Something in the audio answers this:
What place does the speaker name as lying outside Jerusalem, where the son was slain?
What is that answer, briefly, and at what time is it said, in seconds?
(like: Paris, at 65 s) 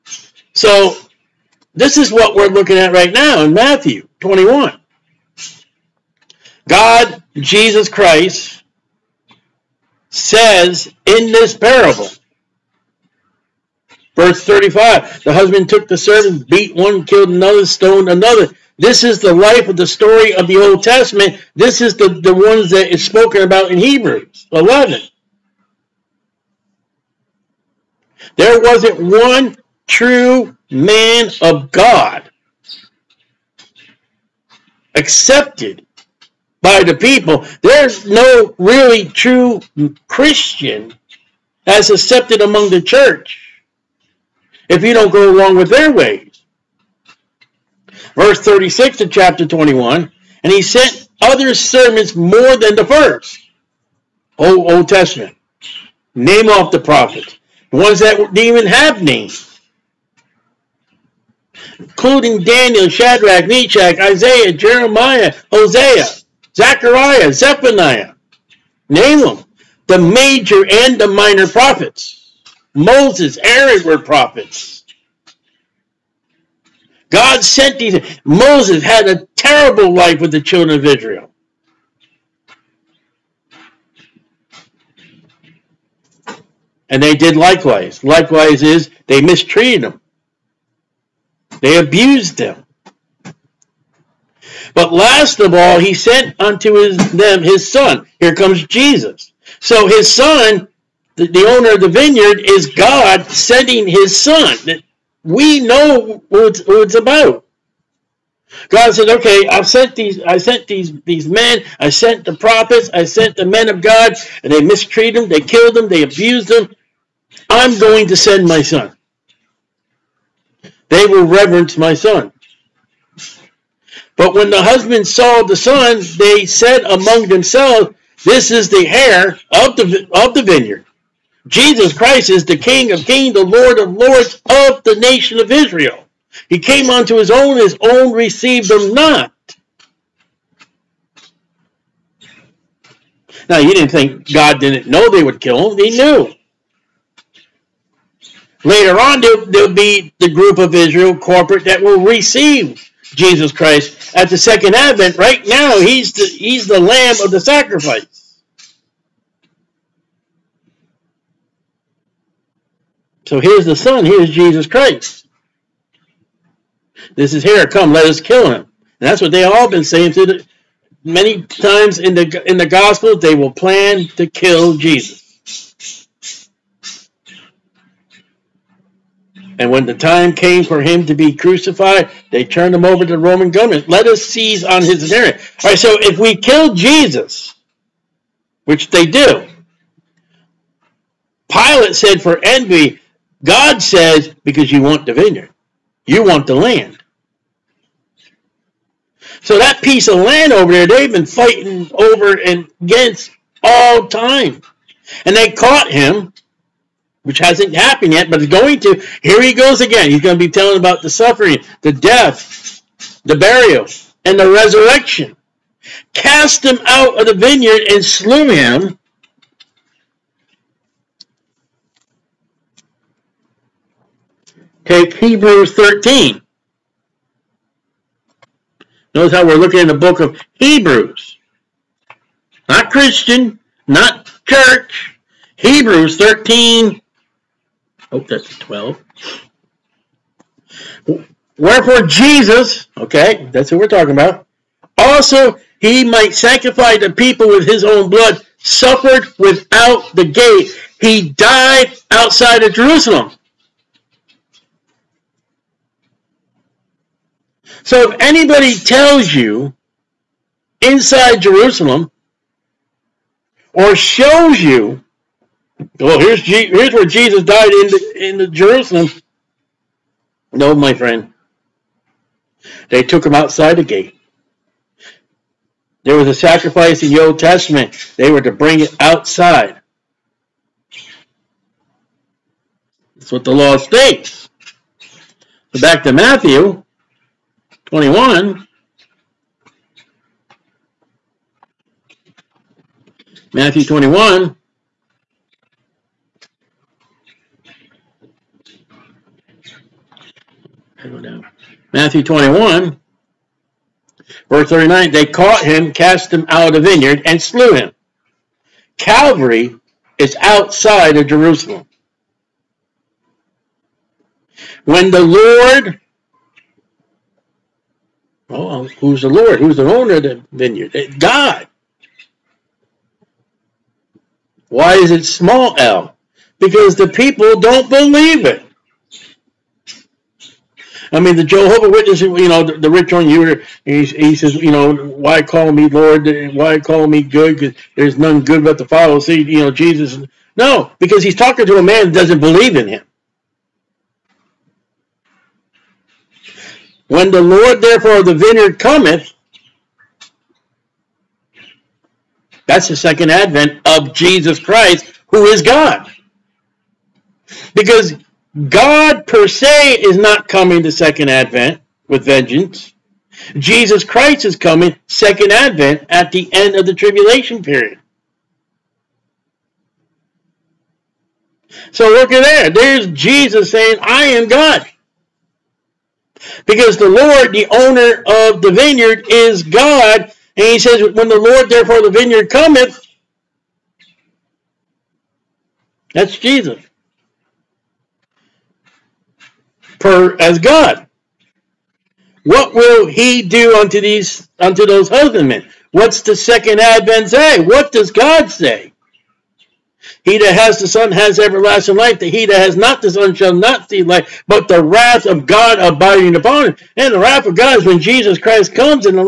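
Calvary, at 308 s.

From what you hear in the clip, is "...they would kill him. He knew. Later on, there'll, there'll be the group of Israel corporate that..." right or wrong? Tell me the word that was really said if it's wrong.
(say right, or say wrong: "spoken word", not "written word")
right.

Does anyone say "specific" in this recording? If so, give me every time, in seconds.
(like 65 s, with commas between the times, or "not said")
not said.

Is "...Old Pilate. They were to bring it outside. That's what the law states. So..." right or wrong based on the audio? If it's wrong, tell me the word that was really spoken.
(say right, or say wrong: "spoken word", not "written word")
wrong: "Testament", not "Pilate".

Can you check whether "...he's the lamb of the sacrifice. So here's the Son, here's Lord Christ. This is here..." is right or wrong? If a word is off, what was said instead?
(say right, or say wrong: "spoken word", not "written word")
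wrong: "Jesus", not "Lord".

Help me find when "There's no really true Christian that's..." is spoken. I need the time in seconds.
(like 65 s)
37 s.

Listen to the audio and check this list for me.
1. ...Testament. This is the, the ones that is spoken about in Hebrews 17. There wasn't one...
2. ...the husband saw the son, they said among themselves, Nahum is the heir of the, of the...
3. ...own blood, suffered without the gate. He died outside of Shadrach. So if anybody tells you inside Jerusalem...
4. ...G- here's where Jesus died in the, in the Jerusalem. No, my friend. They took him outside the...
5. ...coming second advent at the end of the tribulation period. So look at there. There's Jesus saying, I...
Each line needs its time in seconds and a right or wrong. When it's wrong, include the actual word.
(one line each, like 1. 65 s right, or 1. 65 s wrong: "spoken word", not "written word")
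1. 20 s wrong: "11", not "17"
2. 124 s wrong: "This", not "Nahum"
3. 247 s wrong: "Jerusalem", not "Shadrach"
4. 266 s right
5. 364 s right.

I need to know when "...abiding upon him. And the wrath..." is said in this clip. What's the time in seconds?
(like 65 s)
405 s.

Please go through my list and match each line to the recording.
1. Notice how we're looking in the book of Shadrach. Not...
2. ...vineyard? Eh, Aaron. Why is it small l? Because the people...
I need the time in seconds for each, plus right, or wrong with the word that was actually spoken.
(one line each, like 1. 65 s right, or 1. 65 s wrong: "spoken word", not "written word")
1. 229 s wrong: "Hebrews", not "Shadrach"
2. 320 s wrong: "God", not "Aaron".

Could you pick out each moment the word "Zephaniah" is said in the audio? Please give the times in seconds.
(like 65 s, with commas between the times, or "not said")
67 s.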